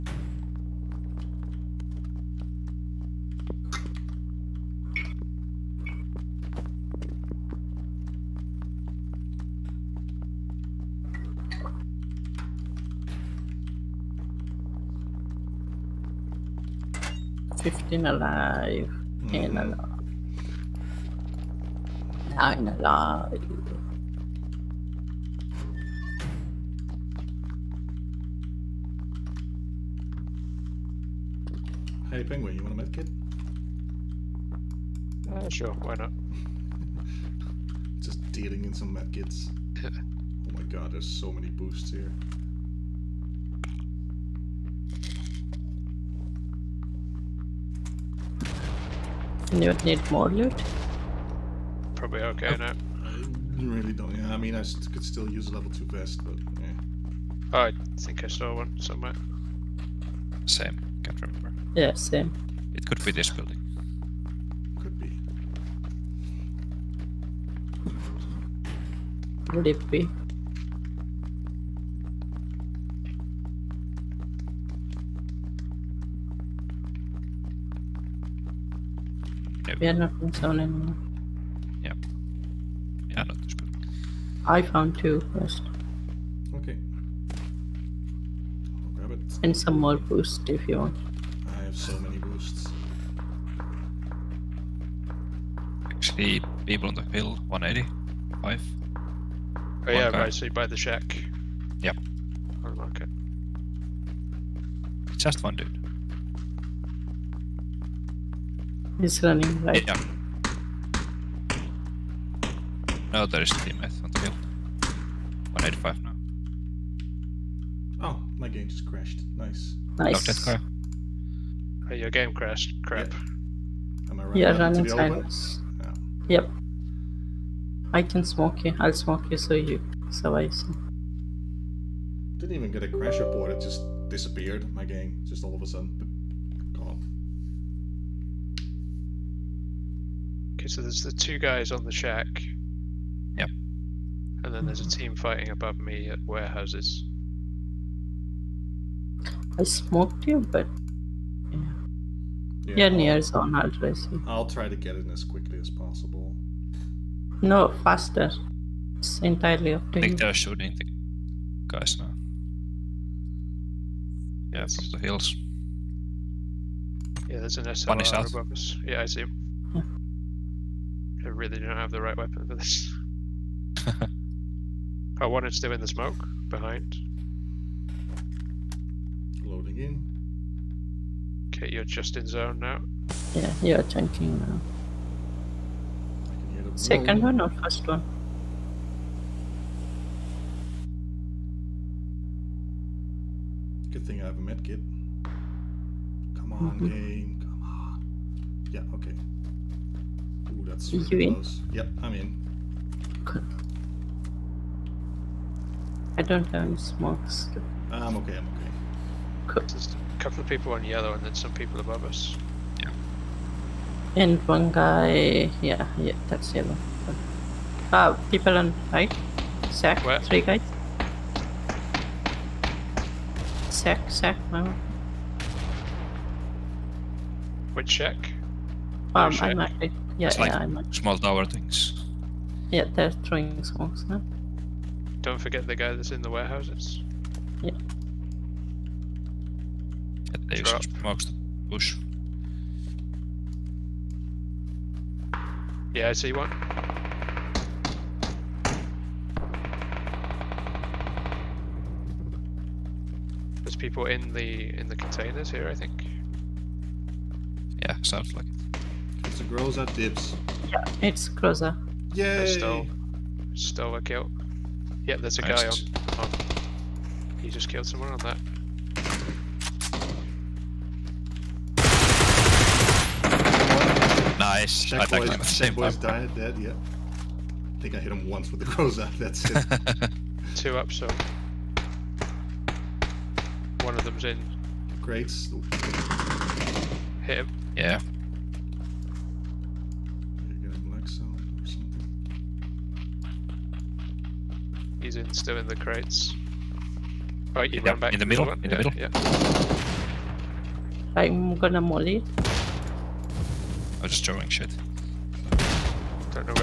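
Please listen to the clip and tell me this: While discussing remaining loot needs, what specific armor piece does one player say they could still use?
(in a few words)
Level two vest.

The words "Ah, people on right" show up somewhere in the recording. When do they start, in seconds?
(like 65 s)
217 s.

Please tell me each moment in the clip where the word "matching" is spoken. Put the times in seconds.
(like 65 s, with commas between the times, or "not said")
not said.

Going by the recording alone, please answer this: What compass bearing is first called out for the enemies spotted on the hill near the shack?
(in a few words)
180.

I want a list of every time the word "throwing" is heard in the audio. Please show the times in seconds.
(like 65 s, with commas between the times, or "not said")
233 s, 304 s.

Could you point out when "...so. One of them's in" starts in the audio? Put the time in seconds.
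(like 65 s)
280 s.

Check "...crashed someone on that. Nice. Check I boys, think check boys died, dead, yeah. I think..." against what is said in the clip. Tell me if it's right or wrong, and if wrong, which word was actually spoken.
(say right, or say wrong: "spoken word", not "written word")
wrong: "killed", not "crashed".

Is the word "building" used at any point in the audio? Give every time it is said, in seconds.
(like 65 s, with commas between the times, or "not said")
63 s, 83 s.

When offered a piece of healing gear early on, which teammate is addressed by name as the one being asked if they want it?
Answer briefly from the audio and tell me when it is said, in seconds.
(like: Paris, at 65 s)
Penguin, at 32 s.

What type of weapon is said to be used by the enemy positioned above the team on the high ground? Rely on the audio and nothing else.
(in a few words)
SLR.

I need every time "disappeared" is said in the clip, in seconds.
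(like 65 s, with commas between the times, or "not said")
134 s.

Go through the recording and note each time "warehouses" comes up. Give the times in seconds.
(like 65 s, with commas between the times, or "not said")
146 s, 236 s.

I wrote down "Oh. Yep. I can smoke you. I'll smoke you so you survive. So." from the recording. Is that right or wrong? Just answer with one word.
right.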